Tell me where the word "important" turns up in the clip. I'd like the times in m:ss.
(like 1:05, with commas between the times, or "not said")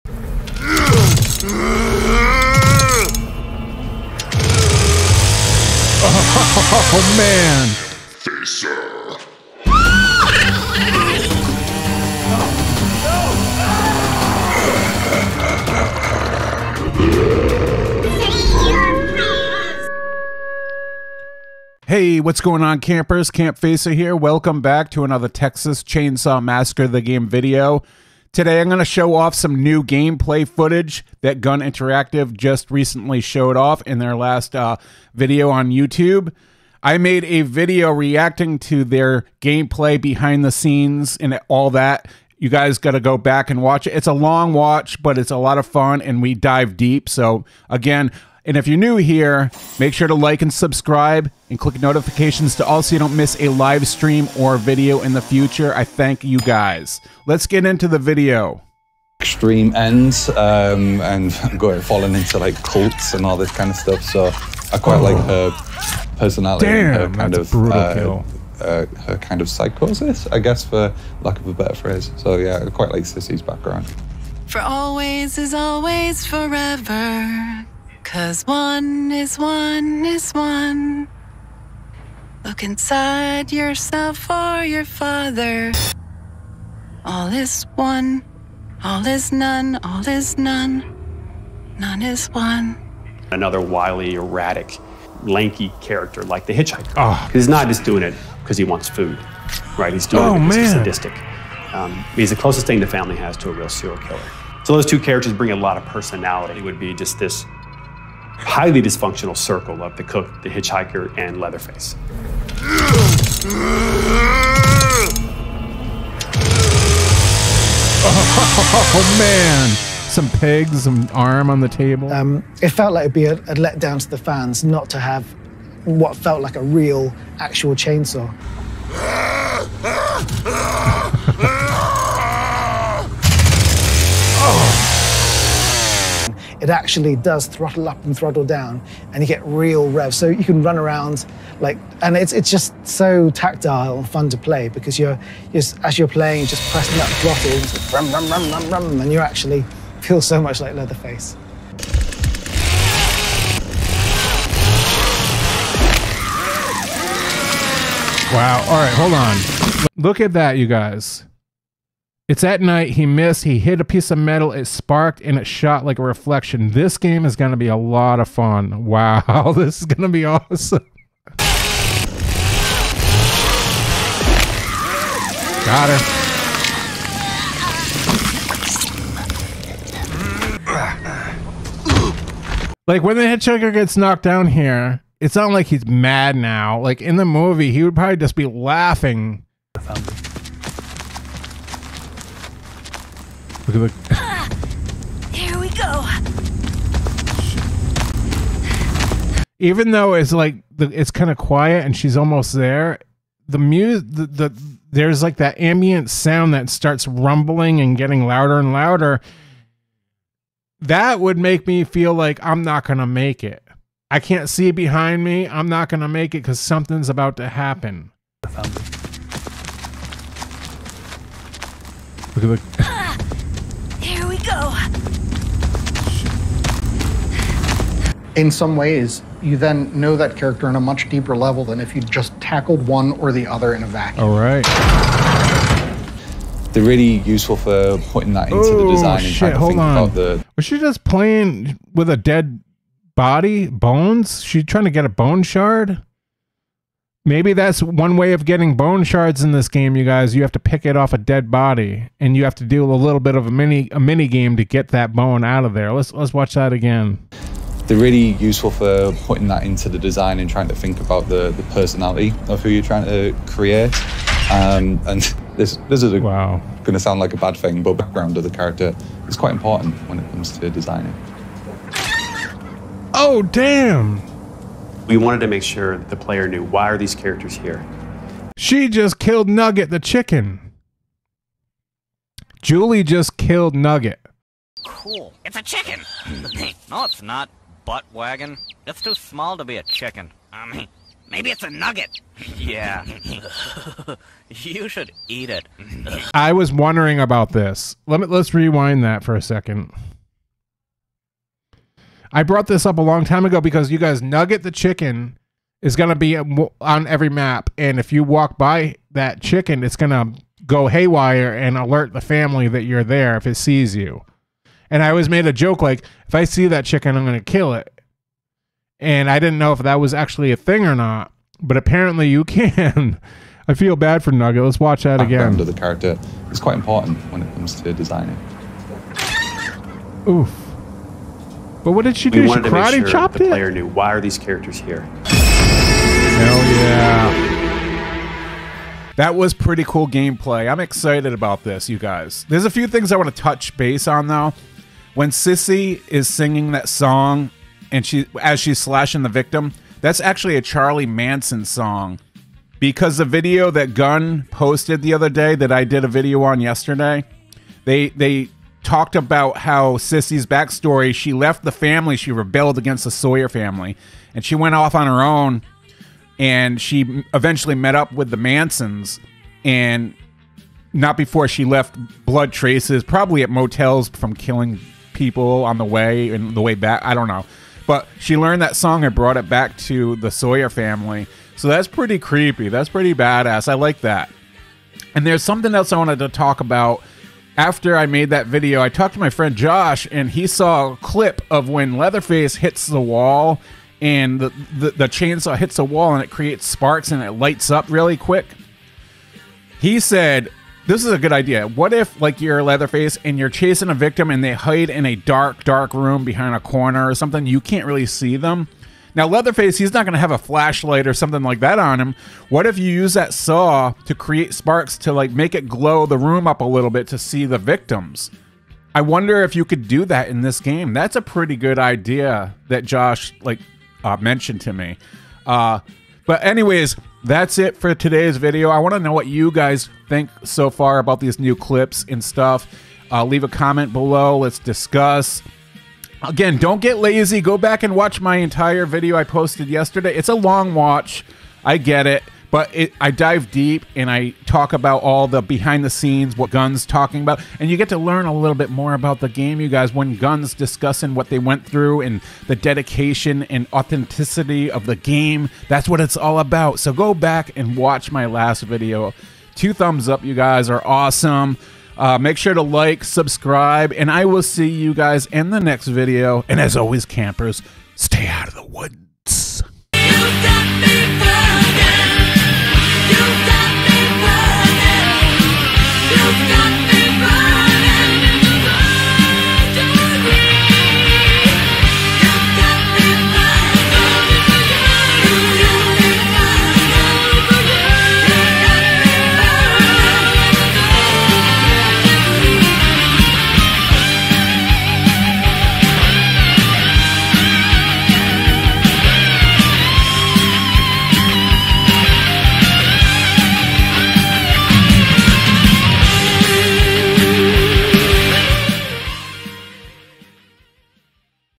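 4:29, 5:26.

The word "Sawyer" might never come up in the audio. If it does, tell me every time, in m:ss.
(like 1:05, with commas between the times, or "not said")
6:03, 6:20.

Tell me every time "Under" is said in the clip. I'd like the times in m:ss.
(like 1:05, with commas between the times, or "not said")
5:25.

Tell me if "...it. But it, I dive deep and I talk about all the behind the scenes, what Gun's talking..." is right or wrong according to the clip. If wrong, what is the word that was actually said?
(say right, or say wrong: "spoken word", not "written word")
right.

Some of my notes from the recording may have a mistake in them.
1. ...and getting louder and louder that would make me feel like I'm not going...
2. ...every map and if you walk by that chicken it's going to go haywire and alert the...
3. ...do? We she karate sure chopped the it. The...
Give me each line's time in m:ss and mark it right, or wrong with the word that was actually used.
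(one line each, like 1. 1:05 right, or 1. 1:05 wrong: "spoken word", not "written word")
1. 3:27 right
2. 5:07 right
3. 5:32 right.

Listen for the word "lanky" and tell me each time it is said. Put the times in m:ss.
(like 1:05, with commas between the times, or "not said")
1:35.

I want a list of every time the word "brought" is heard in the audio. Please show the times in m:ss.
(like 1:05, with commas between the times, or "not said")
5:02, 6:19.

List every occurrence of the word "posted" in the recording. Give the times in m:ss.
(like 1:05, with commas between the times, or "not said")
5:54, 7:19.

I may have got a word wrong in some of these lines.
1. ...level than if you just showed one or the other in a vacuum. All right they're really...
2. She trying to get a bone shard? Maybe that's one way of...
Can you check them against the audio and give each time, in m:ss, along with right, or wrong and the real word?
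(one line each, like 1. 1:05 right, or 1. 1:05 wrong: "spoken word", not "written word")
1. 3:51 wrong: "tackled", not "showed"
2. 4:04 right.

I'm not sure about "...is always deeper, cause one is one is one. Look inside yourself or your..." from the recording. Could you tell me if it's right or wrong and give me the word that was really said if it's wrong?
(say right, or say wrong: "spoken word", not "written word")
wrong: "forever", not "deeper".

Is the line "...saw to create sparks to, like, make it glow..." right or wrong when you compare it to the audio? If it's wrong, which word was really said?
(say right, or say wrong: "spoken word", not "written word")
right.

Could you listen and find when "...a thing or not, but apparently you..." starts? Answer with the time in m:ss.
5:20.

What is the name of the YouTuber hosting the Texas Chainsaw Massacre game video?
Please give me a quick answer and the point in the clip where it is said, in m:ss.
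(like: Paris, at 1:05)
Campfacer, at 0:23.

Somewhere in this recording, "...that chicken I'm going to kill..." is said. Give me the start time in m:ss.
5:16.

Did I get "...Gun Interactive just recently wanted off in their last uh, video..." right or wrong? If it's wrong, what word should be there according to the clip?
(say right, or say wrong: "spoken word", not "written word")
wrong: "showed", not "wanted".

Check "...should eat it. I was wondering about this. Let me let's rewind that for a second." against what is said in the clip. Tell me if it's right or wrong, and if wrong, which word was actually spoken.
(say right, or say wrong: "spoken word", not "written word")
right.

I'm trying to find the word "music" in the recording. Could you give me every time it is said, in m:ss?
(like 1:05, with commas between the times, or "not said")
3:23.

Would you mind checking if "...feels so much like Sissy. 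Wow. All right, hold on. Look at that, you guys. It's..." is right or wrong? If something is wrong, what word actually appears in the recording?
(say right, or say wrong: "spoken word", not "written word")
wrong: "Leatherface", not "Sissy".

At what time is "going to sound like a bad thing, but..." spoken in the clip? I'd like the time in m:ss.
4:26.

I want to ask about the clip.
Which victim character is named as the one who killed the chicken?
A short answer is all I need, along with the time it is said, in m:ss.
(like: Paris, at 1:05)
Julie, at 4:42.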